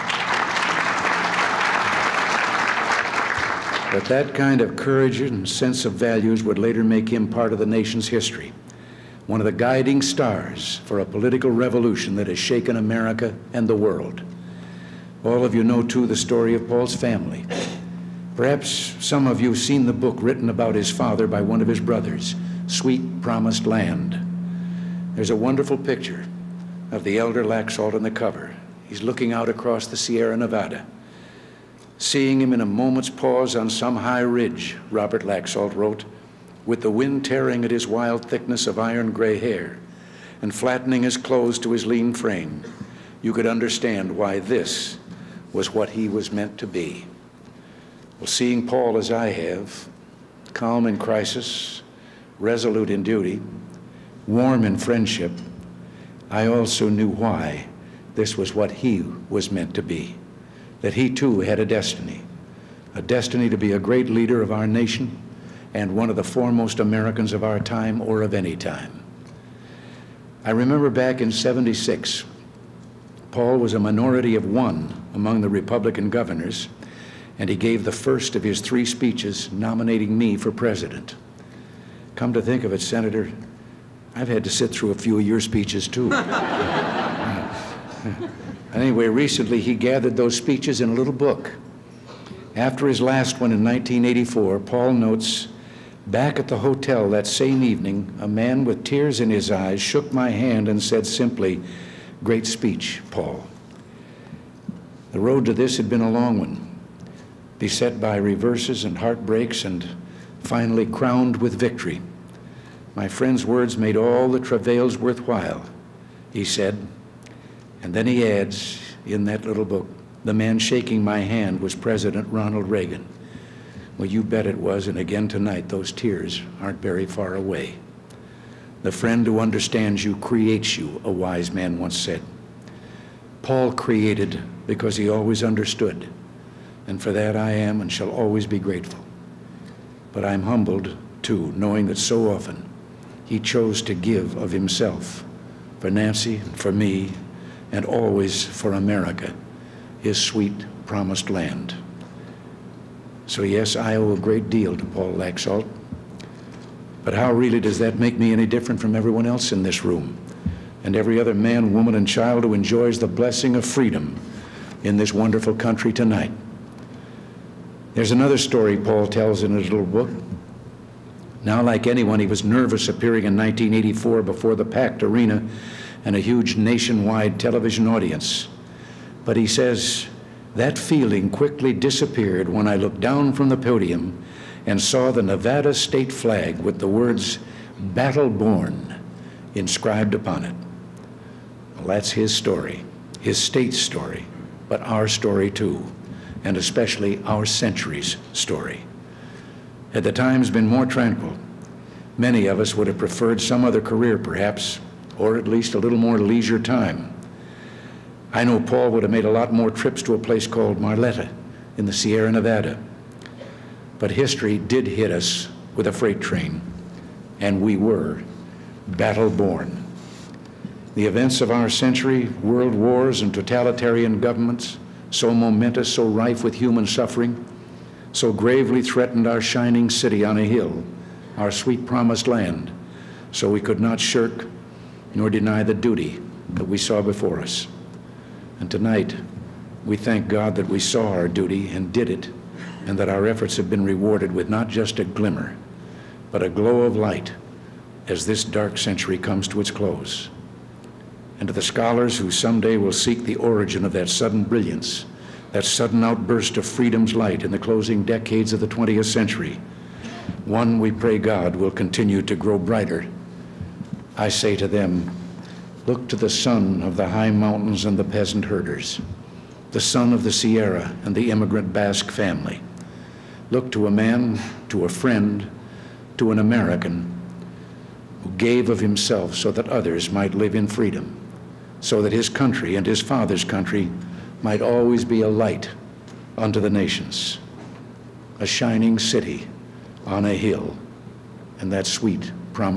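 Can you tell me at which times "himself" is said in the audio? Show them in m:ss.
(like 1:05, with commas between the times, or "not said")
2:24, 4:38.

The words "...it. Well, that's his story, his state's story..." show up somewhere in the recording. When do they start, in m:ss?
3:10.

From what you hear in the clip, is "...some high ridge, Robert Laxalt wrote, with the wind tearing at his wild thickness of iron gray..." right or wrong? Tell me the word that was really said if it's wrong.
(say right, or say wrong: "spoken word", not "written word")
right.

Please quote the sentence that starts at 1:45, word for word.
The road to this had been a long one, beset by reverses and heartbreaks, and finally crowned with victory.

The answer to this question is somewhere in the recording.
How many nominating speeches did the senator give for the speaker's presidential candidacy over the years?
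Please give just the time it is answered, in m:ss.
1:18.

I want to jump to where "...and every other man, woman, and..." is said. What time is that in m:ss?
2:40.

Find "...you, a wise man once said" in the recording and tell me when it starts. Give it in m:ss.
2:10.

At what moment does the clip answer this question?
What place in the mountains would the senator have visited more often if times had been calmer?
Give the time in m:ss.
3:30.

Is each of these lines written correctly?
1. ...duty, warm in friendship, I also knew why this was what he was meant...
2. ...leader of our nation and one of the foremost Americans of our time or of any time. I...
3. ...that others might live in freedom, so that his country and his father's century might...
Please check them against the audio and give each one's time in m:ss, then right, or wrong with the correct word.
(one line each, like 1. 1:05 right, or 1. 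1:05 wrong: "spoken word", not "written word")
1. 0:53 right
2. 1:04 right
3. 4:39 wrong: "country", not "century".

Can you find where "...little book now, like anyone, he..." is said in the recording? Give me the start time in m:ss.
2:49.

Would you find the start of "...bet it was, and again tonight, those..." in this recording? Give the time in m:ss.
2:04.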